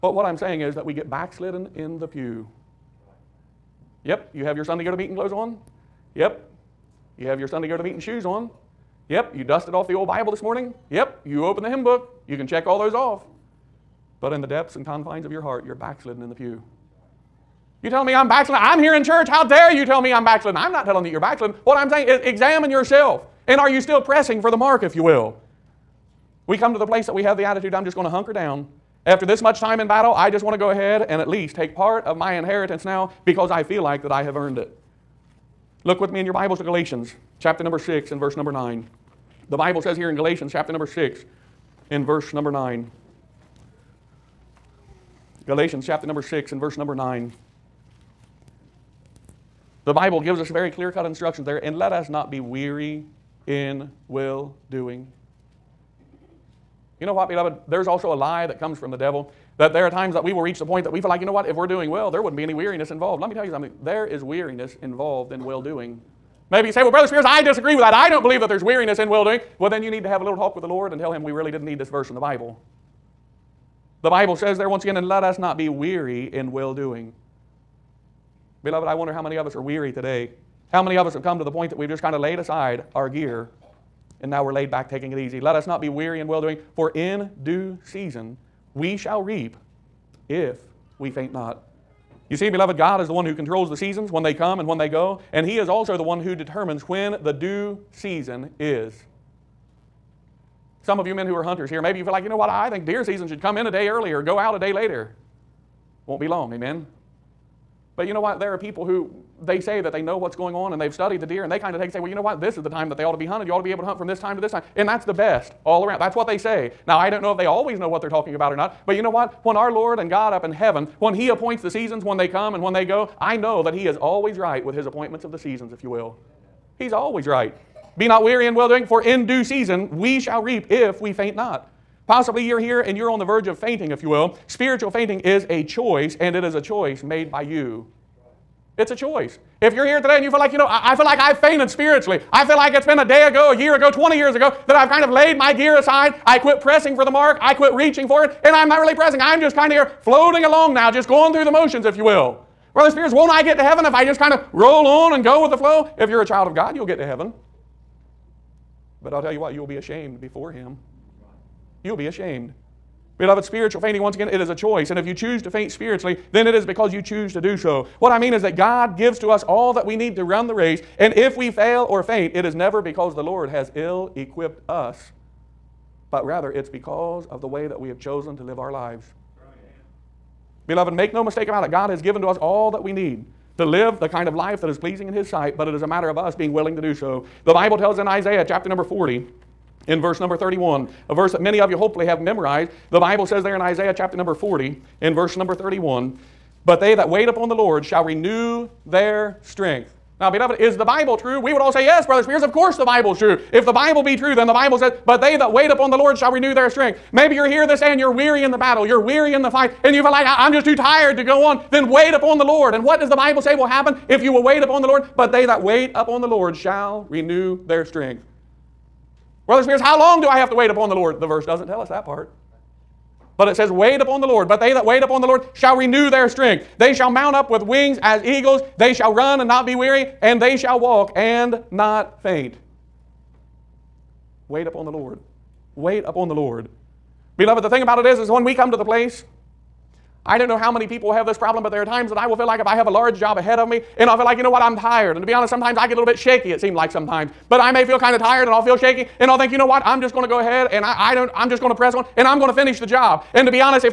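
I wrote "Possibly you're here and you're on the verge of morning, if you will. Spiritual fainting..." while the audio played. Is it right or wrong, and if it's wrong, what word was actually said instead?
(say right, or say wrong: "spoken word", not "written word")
wrong: "fainting", not "morning".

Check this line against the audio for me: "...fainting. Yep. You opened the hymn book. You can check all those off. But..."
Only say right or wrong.
wrong.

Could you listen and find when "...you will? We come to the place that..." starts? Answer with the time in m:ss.
0:24.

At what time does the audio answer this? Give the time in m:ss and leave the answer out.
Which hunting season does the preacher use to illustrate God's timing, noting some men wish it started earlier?
1:42.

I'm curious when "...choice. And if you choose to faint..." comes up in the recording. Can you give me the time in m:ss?
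2:44.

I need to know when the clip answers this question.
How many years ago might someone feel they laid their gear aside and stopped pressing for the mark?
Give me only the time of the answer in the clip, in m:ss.
2:23.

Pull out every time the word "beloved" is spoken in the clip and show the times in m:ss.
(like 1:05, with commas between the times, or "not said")
0:57, 1:18, 1:32, 2:43, 3:00, 3:20, 3:57.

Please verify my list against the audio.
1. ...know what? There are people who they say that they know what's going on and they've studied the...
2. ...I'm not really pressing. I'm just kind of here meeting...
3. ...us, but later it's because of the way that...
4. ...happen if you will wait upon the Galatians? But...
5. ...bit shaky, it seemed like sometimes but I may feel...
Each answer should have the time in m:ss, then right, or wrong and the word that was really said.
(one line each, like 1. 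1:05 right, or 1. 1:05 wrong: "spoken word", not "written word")
1. 1:48 right
2. 2:28 wrong: "floating", not "meeting"
3. 2:54 wrong: "rather", not "later"
4. 3:33 wrong: "Lord", not "Galatians"
5. 4:06 right.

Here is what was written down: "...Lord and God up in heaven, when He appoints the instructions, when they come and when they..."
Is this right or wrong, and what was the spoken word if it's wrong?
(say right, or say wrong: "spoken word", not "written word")
wrong: "seasons", not "instructions".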